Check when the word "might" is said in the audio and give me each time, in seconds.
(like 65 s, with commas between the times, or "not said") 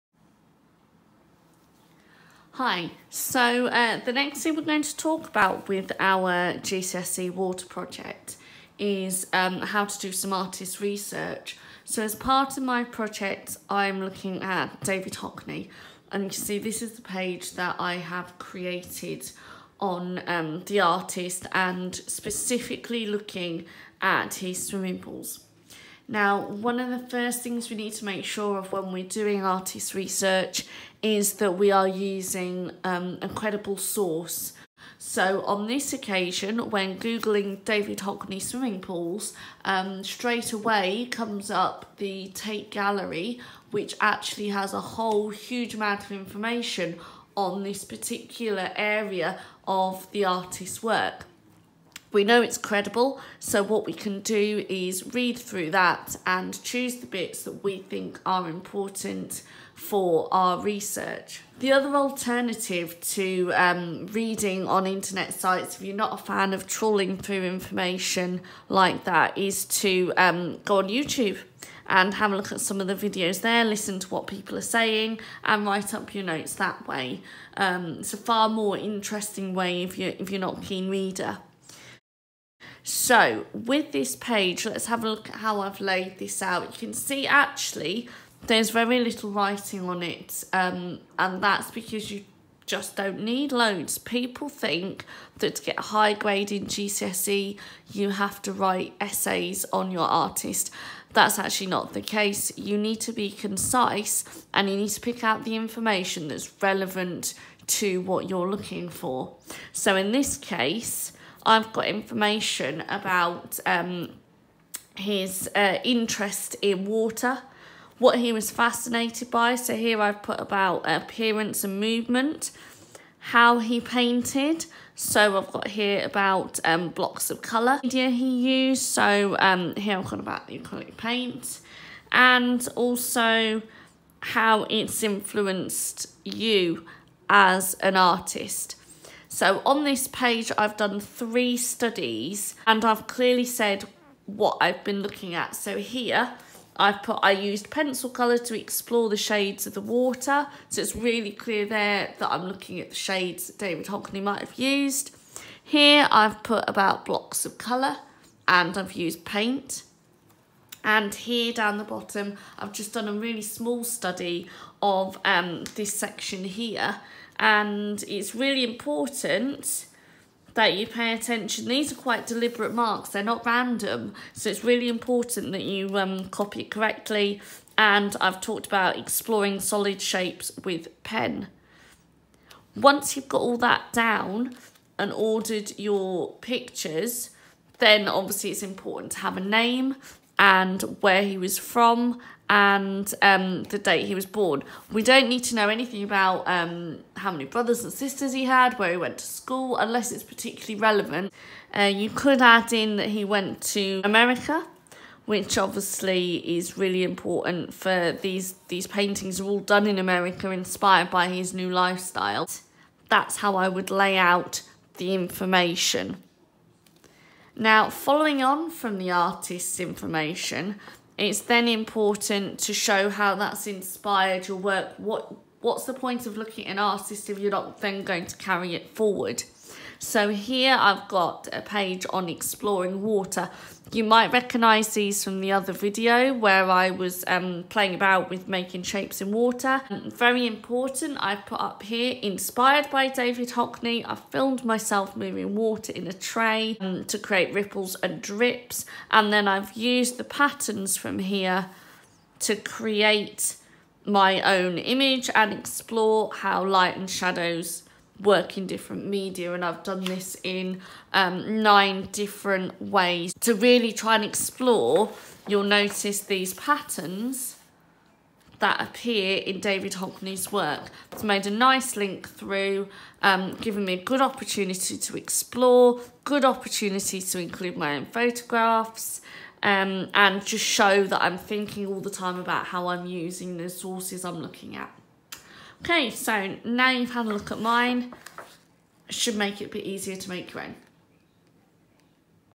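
154 s, 234 s.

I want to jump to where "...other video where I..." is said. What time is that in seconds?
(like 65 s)
235 s.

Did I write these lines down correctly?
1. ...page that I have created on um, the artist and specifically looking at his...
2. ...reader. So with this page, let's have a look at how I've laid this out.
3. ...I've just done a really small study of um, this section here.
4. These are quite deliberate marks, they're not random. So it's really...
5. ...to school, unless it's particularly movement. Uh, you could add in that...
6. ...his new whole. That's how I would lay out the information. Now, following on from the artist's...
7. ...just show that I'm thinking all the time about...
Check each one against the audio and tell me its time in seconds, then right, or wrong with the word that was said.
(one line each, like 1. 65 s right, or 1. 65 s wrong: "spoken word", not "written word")
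1. 17 s right
2. 80 s right
3. 162 s right
4. 171 s right
5. 199 s wrong: "relevant", not "movement"
6. 211 s wrong: "lifestyle", not "whole"
7. 280 s right.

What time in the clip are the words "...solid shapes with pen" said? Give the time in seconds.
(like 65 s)
179 s.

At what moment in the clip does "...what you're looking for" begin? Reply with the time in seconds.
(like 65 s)
108 s.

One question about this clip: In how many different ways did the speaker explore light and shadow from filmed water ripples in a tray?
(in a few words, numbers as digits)
9.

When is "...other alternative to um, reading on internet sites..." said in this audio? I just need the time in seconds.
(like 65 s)
61 s.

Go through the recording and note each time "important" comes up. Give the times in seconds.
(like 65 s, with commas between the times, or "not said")
58 s, 168 s, 174 s, 188 s, 207 s, 221 s, 240 s.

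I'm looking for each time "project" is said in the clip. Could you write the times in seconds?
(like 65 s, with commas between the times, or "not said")
7 s, 12 s.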